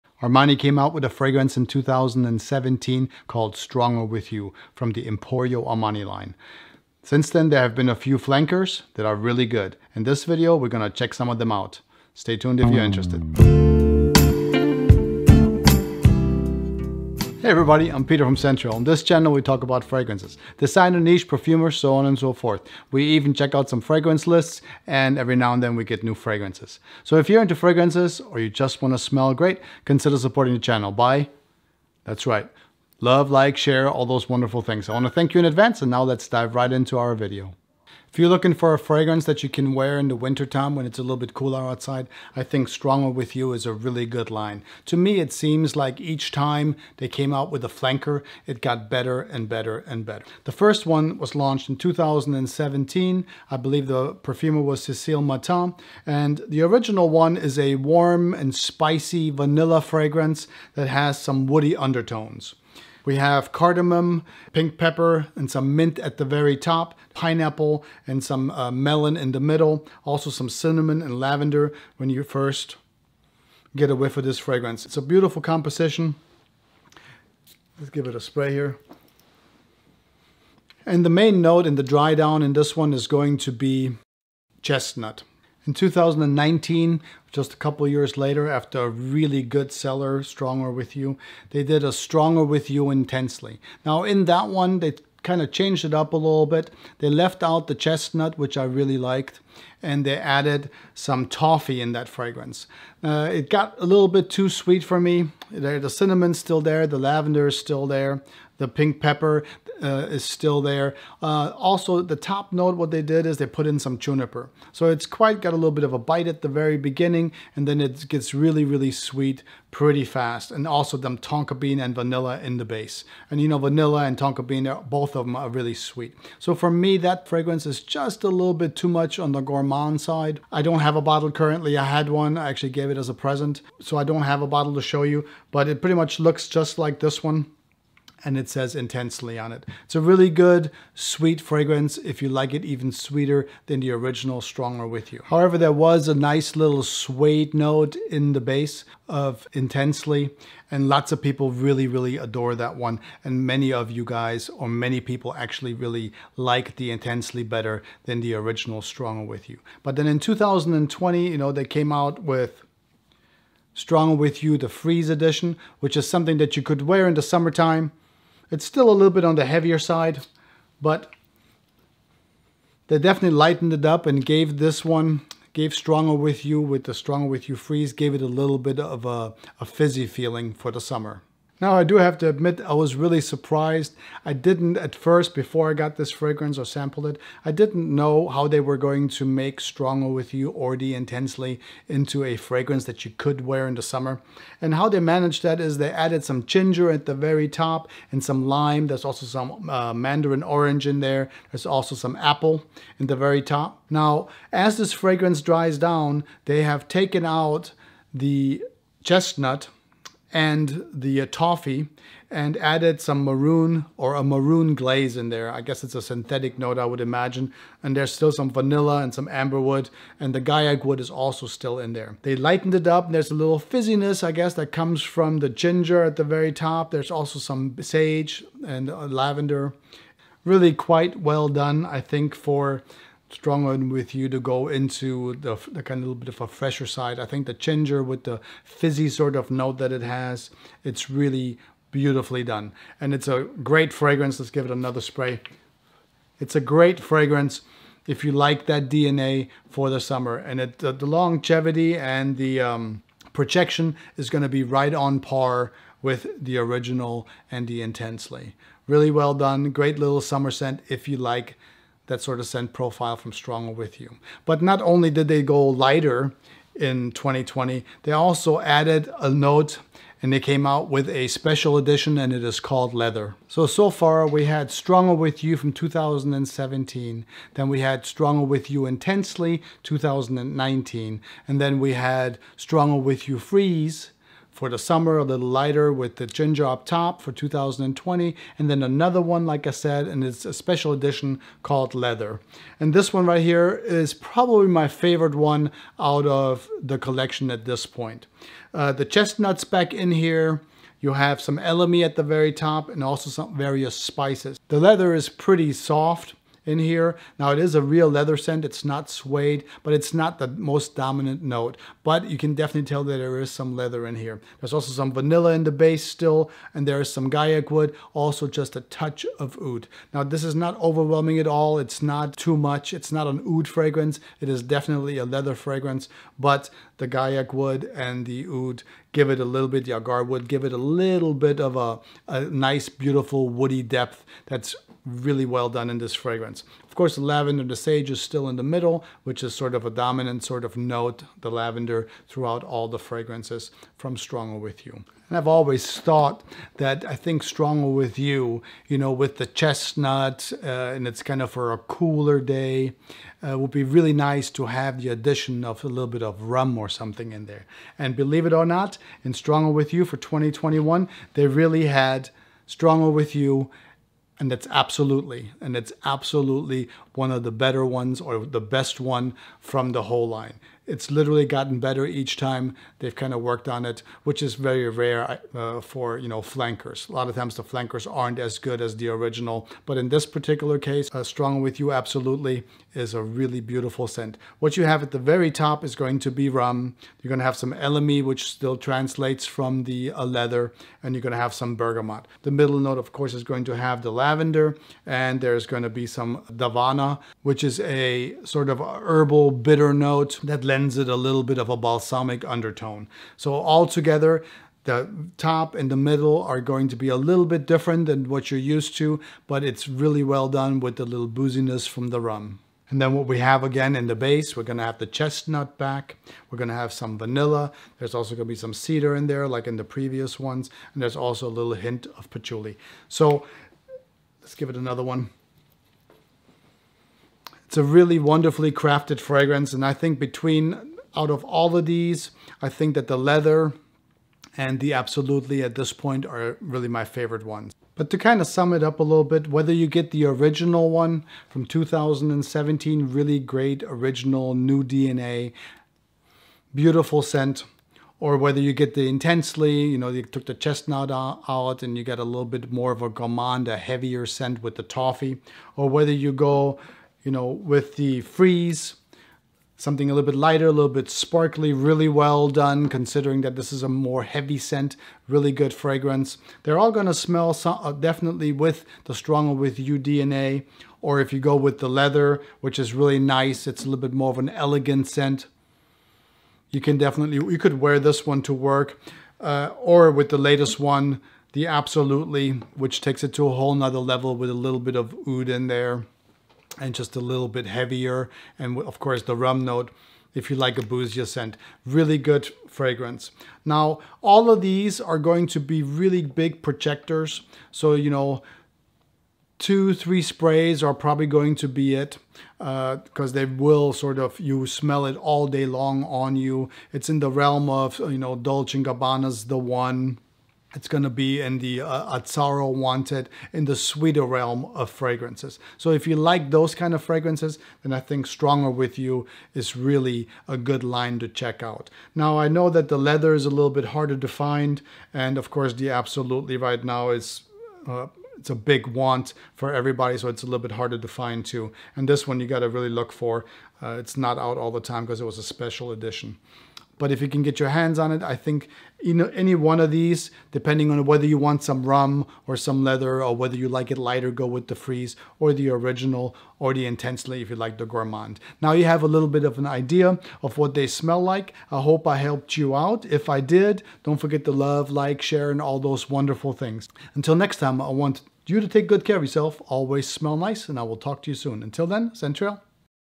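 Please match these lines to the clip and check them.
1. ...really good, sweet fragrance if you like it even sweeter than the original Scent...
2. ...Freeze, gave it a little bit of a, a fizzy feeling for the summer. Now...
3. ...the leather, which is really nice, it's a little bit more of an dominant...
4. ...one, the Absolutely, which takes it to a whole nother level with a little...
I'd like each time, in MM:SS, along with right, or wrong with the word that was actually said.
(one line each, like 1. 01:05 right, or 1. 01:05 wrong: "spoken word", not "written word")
1. 02:20 wrong: "Stronger", not "Scent"
2. 02:57 right
3. 07:51 wrong: "elegant", not "dominant"
4. 08:00 right.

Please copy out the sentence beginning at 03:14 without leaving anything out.
And how they managed that is they added some ginger at the very top and some lime.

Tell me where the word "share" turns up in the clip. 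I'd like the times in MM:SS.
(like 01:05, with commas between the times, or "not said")
00:33, 09:15.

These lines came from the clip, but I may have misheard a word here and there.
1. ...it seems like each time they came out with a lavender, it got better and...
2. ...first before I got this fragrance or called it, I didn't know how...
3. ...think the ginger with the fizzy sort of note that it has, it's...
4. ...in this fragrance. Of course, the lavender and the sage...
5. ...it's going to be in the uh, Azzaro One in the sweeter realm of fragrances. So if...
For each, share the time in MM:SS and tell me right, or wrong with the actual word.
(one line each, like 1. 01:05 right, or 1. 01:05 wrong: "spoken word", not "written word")
1. 00:45 wrong: "flanker", not "lavender"
2. 03:04 wrong: "sampled", not "called"
3. 03:57 right
4. 05:35 right
5. 08:30 wrong: "Wanted", not "One".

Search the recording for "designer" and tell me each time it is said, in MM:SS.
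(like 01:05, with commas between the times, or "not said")
00:20.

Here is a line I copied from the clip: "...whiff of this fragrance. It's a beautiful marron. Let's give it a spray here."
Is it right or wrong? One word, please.
wrong.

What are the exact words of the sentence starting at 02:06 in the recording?
So for me, that fragrance is just a little bit too much on the the gourmand side.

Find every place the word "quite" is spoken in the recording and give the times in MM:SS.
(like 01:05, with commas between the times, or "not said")
01:55, 03:50.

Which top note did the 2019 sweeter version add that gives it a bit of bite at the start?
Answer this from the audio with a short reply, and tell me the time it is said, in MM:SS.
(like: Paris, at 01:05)
Juniper, at 01:53.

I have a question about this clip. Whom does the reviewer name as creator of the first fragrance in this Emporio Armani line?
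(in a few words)
Cécile Matton.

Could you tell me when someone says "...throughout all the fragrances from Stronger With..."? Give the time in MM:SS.
05:42.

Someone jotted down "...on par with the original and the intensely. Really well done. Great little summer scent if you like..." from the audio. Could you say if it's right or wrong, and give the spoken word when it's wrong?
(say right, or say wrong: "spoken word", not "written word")
right.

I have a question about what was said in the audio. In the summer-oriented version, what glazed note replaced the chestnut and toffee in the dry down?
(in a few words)
Marron glacé.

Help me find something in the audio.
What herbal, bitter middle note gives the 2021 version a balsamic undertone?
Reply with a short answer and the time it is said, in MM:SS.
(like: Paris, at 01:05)
Davana, at 06:36.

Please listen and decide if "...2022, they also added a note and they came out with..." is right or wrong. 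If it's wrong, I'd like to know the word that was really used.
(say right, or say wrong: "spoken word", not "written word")
wrong: "2020", not "2022".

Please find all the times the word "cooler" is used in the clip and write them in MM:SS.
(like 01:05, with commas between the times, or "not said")
00:41, 05:51.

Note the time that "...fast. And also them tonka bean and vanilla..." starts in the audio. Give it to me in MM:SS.
02:00.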